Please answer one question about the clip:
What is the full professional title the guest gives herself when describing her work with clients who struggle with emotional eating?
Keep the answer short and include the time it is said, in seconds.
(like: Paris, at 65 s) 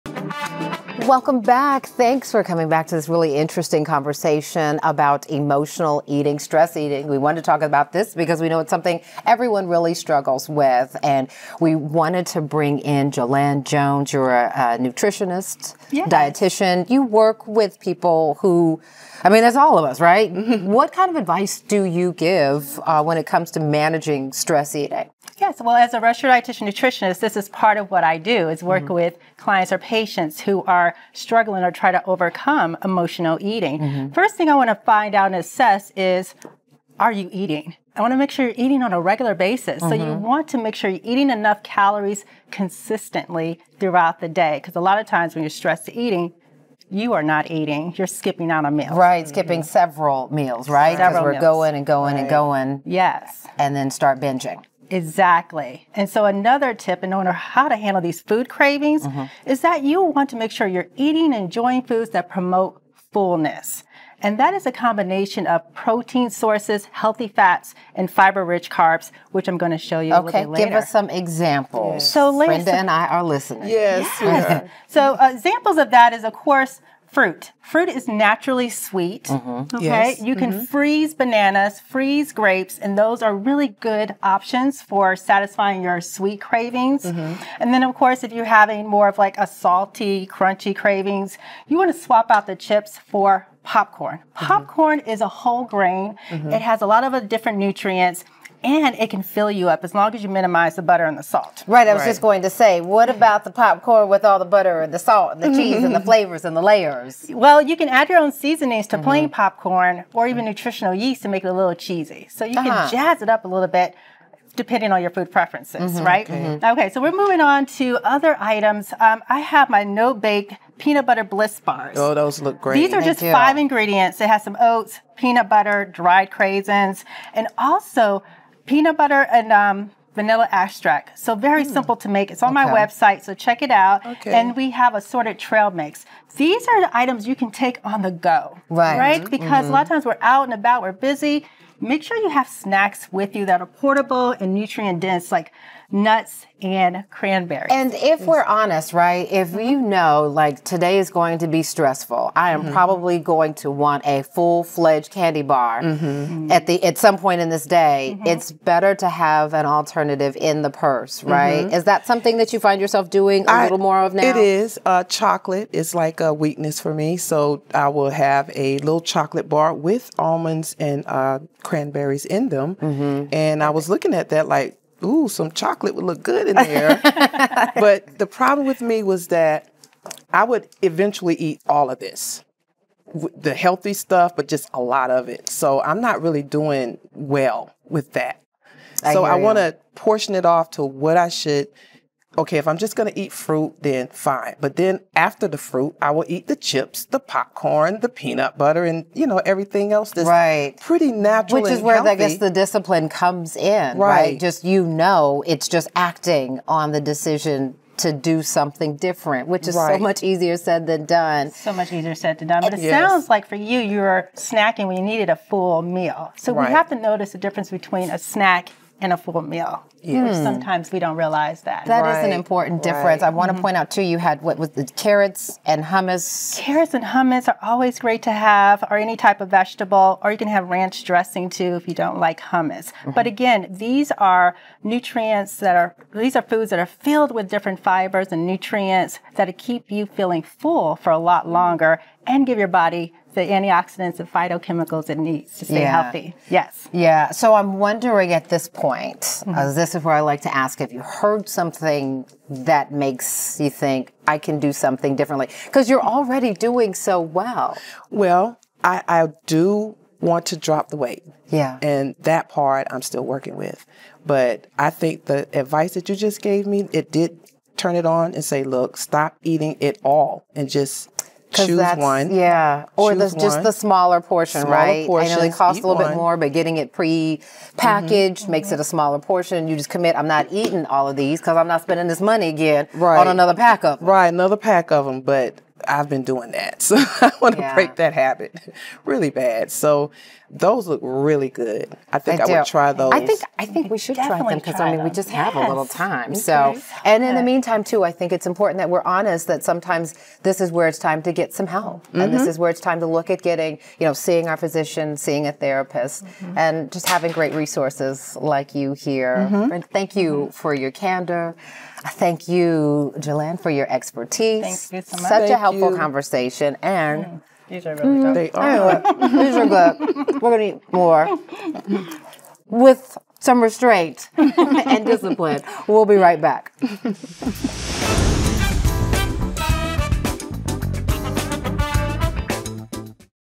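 registered dietitian nutritionist, at 25 s.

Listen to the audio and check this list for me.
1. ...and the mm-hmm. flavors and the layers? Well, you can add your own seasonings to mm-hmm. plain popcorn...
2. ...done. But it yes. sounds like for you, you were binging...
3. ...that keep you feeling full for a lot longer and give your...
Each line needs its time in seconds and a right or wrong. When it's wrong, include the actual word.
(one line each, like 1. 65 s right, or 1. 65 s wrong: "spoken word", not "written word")
1. 105 s right
2. 212 s wrong: "snacking", not "binging"
3. 239 s right.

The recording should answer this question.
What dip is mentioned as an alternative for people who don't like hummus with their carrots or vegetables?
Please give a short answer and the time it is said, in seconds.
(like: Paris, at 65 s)
ranch dressing, at 230 s.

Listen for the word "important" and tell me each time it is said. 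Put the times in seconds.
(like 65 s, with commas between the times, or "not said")
222 s, 298 s.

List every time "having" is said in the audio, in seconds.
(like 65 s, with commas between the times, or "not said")
88 s, 307 s.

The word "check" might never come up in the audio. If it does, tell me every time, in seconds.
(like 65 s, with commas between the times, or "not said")
133 s.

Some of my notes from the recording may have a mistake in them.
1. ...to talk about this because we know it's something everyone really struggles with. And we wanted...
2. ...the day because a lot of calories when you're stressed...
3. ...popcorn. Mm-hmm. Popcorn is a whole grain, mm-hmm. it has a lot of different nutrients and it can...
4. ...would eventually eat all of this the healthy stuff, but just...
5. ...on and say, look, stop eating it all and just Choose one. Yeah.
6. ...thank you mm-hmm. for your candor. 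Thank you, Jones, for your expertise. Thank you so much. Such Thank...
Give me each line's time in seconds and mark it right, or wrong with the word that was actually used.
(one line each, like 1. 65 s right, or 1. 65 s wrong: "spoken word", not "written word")
1. 7 s right
2. 44 s wrong: "times", not "calories"
3. 93 s right
4. 180 s right
5. 268 s right
6. 309 s wrong: "Jerlyn", not "Jones".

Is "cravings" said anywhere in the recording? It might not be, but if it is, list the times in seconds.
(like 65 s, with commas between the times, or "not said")
58 s, 86 s, 90 s.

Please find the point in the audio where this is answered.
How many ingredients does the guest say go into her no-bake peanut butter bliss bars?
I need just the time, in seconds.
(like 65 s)
123 s.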